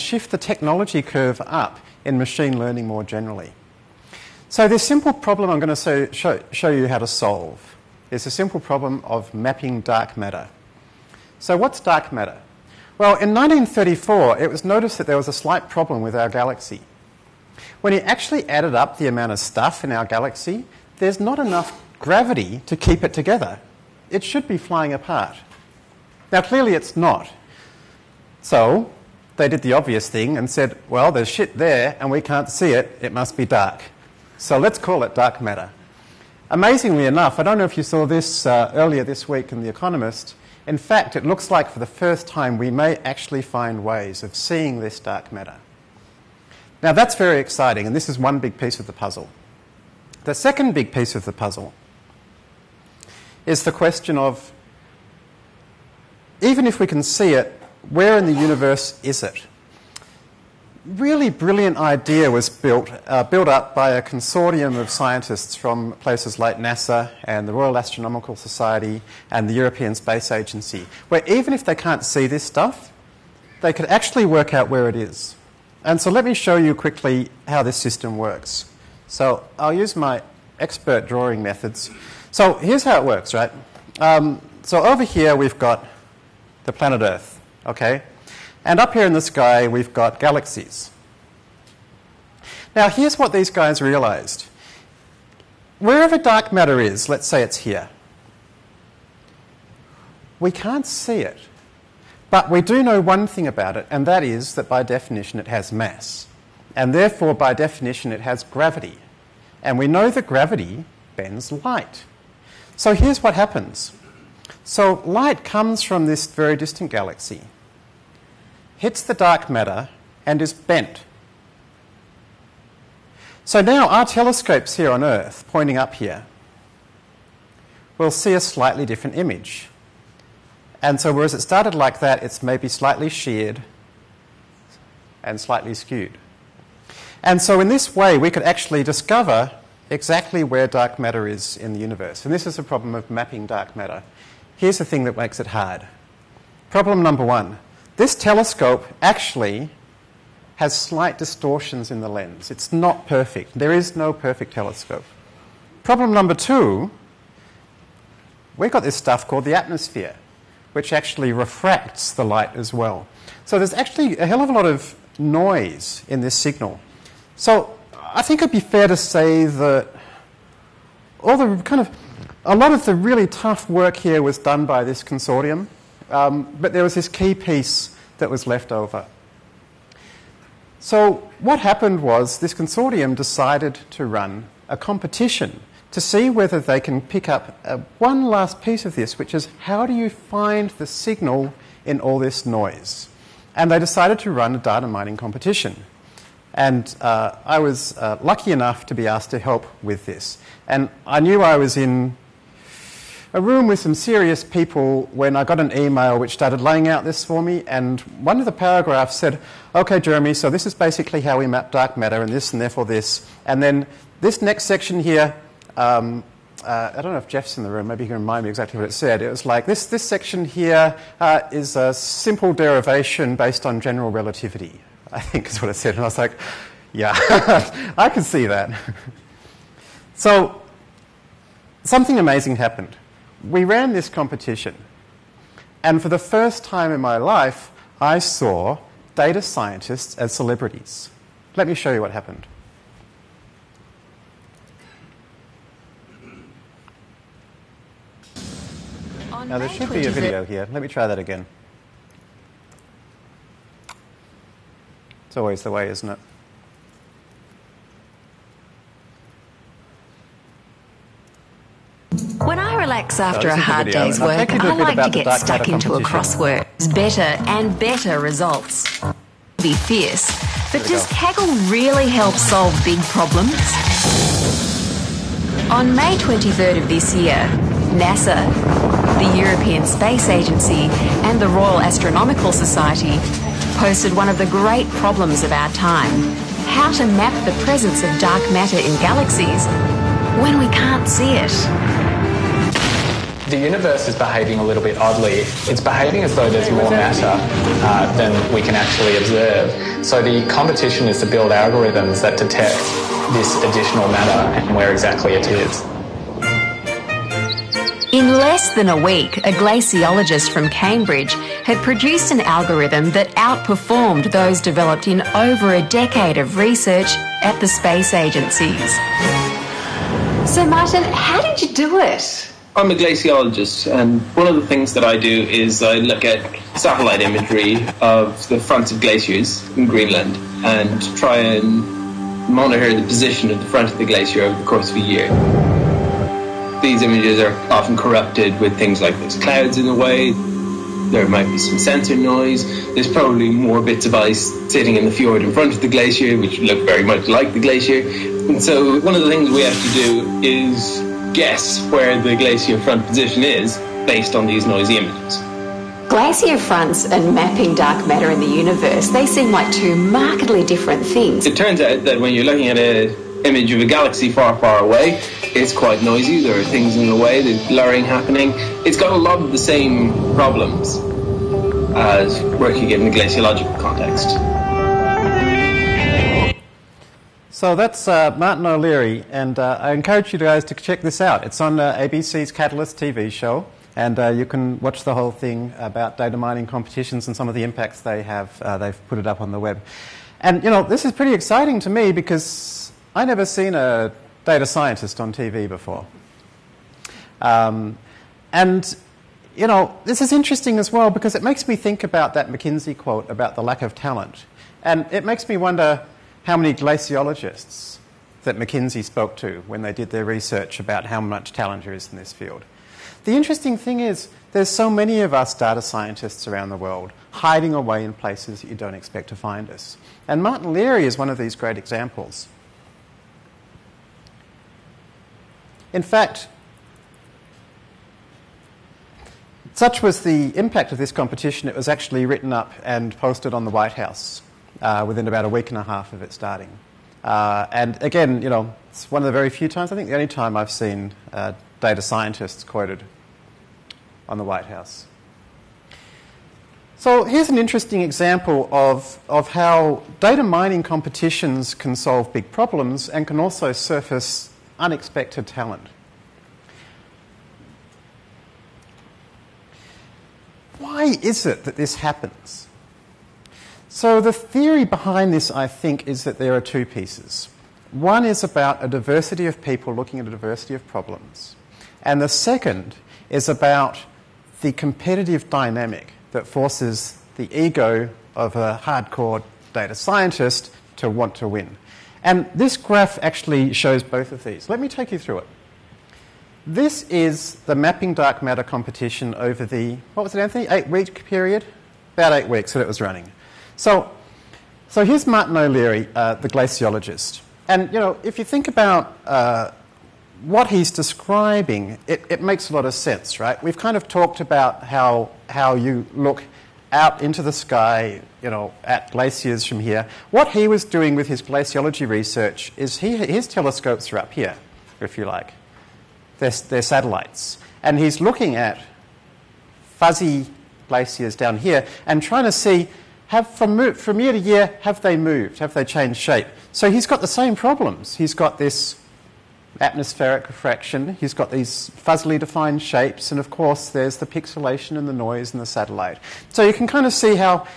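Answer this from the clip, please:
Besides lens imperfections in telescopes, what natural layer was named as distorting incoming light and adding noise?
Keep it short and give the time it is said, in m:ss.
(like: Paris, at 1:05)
the atmosphere, at 2:39.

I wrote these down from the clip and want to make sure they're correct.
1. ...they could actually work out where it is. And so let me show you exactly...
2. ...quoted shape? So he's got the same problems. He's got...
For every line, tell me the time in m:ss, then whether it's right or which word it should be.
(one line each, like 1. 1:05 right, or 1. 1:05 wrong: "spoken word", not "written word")
1. 1:13 wrong: "quickly", not "exactly"
2. 8:45 wrong: "changed", not "quoted".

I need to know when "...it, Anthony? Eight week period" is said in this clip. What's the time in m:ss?
8:10.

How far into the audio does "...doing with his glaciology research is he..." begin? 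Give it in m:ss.
8:30.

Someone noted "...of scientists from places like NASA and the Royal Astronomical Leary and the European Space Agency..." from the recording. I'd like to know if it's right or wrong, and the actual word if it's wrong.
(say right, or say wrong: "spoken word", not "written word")
wrong: "Society", not "Leary".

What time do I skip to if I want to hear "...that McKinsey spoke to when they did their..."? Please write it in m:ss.
6:48.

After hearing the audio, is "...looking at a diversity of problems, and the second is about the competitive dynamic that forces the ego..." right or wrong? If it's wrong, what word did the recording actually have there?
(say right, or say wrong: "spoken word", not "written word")
right.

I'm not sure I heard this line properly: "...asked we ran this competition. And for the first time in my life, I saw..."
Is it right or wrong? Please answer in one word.
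wrong.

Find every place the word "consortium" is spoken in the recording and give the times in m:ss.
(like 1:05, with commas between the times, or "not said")
1:04, 2:55, 3:02.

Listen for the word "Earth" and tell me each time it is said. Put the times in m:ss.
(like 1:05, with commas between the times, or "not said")
1:27, 2:05.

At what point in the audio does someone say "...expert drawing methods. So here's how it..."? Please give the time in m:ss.
1:20.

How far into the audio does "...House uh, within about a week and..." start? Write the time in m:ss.
7:13.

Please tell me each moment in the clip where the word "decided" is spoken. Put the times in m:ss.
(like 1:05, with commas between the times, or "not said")
3:03, 3:13.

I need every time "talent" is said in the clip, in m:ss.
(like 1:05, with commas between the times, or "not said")
6:43, 6:51, 7:35.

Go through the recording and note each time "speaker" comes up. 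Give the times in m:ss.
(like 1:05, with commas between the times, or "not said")
not said.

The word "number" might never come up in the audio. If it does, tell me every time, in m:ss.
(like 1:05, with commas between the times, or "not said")
2:27, 2:36.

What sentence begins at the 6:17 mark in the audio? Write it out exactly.
So that's uh, Martin O'Leary, and uh, I encourage you guys to check this out.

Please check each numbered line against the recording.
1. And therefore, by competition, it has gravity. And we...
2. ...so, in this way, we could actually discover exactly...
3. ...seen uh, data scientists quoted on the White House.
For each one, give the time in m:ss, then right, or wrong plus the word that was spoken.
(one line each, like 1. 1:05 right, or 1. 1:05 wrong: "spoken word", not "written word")
1. 1:46 wrong: "definition", not "competition"
2. 2:17 right
3. 7:20 right.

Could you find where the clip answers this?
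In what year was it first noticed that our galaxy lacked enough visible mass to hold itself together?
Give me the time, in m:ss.
0:13.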